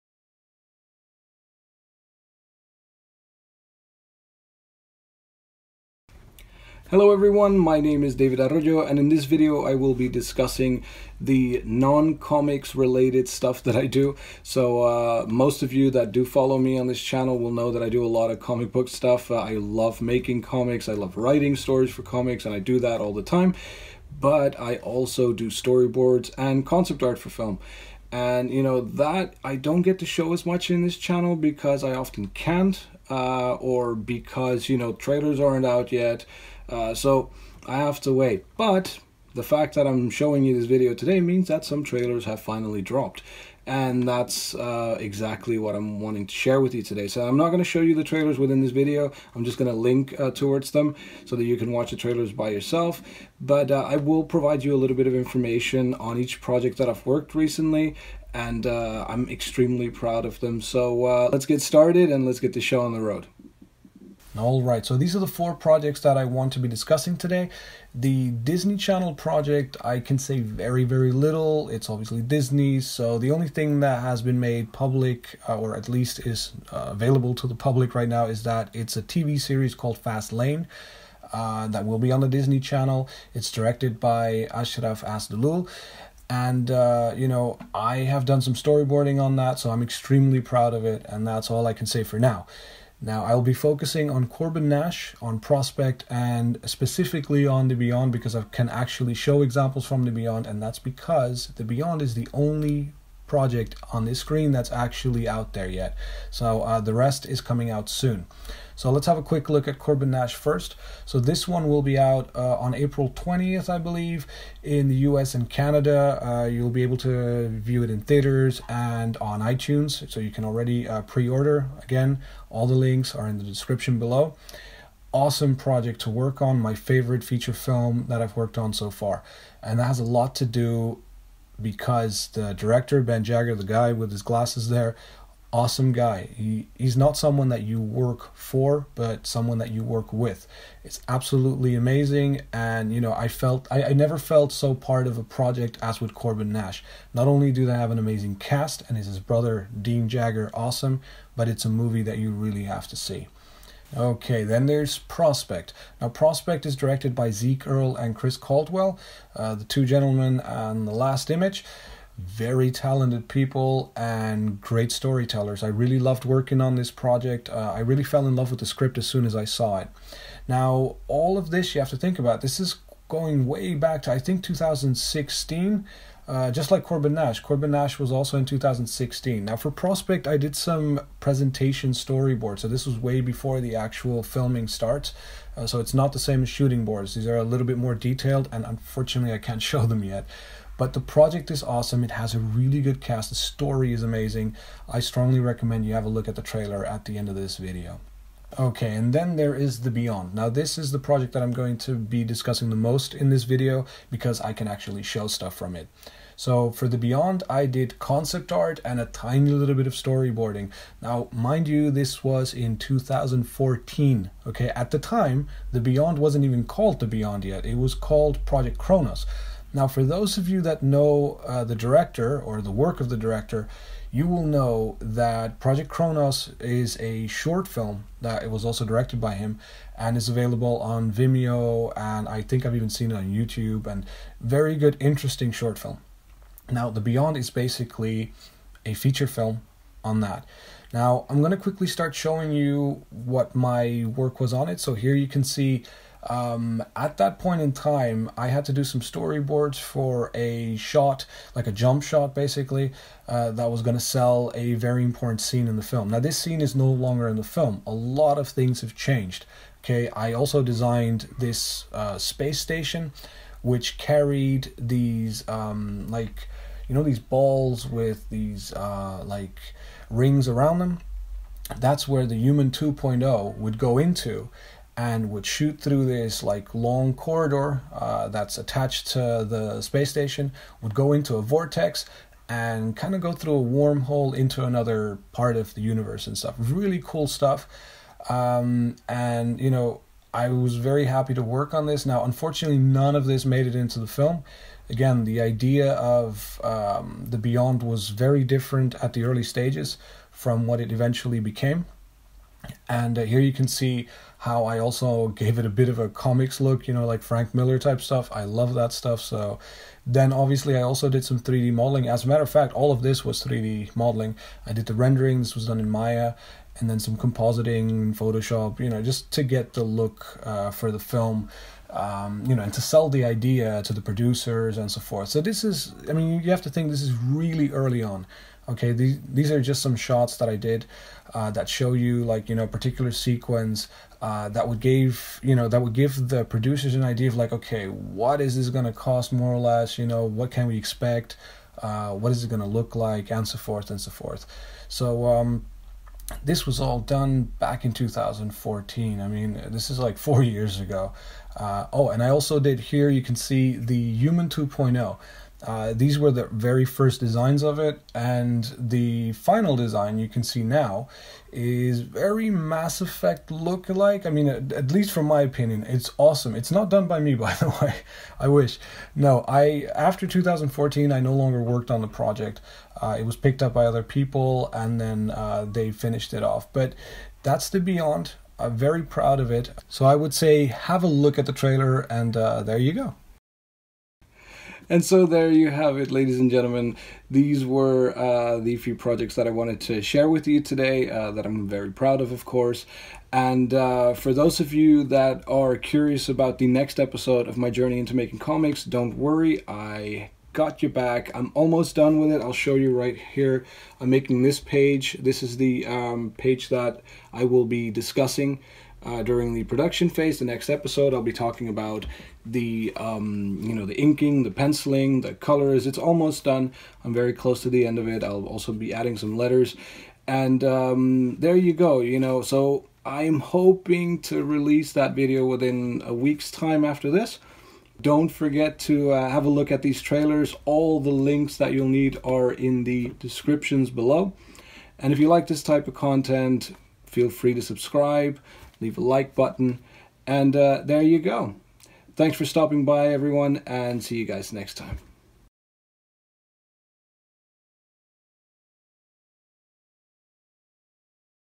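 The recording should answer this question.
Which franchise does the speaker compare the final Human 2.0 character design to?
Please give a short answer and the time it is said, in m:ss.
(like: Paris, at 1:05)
Mass Effect, at 6:02.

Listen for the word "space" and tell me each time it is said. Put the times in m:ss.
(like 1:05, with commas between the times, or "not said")
4:22, 4:39.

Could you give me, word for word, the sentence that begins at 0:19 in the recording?
Uh, I love making comics, I love writing stories for comics and I do that all the time.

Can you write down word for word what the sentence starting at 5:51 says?
Uh, oh, and I also did here, you can see the Human 2.0.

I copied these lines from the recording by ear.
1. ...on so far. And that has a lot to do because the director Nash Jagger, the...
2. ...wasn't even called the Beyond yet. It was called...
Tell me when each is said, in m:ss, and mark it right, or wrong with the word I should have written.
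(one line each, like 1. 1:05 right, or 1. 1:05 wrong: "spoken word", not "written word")
1. 2:08 wrong: "Ben", not "Nash"
2. 3:36 right.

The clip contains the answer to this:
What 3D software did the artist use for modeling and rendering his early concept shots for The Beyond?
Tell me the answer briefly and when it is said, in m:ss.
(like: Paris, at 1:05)
Maya, at 5:15.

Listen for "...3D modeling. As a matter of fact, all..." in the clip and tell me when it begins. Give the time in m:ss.
5:11.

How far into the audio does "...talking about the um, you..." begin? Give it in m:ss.
6:51.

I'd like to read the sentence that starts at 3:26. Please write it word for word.
So for the Beyond, I did concept art and a tiny little bit of storyboarding.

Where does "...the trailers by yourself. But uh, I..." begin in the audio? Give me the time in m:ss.
0:51.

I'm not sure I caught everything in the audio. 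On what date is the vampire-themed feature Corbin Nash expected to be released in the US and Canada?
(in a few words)
April 20th.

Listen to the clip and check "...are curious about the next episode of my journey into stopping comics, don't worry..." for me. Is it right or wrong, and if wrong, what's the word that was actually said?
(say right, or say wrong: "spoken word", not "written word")
wrong: "making", not "stopping".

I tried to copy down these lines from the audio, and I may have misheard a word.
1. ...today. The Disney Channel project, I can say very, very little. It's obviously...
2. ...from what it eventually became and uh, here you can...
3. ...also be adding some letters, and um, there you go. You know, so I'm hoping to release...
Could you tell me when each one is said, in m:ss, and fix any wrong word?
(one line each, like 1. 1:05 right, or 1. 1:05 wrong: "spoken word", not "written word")
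1. 1:07 right
2. 5:00 right
3. 6:58 right.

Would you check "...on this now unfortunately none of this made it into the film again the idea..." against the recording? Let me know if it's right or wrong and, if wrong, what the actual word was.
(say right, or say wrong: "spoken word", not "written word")
right.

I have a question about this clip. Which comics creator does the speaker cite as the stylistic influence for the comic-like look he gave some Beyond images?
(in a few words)
Frank Miller.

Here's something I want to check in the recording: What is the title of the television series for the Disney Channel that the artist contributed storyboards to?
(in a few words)
Fast Layne.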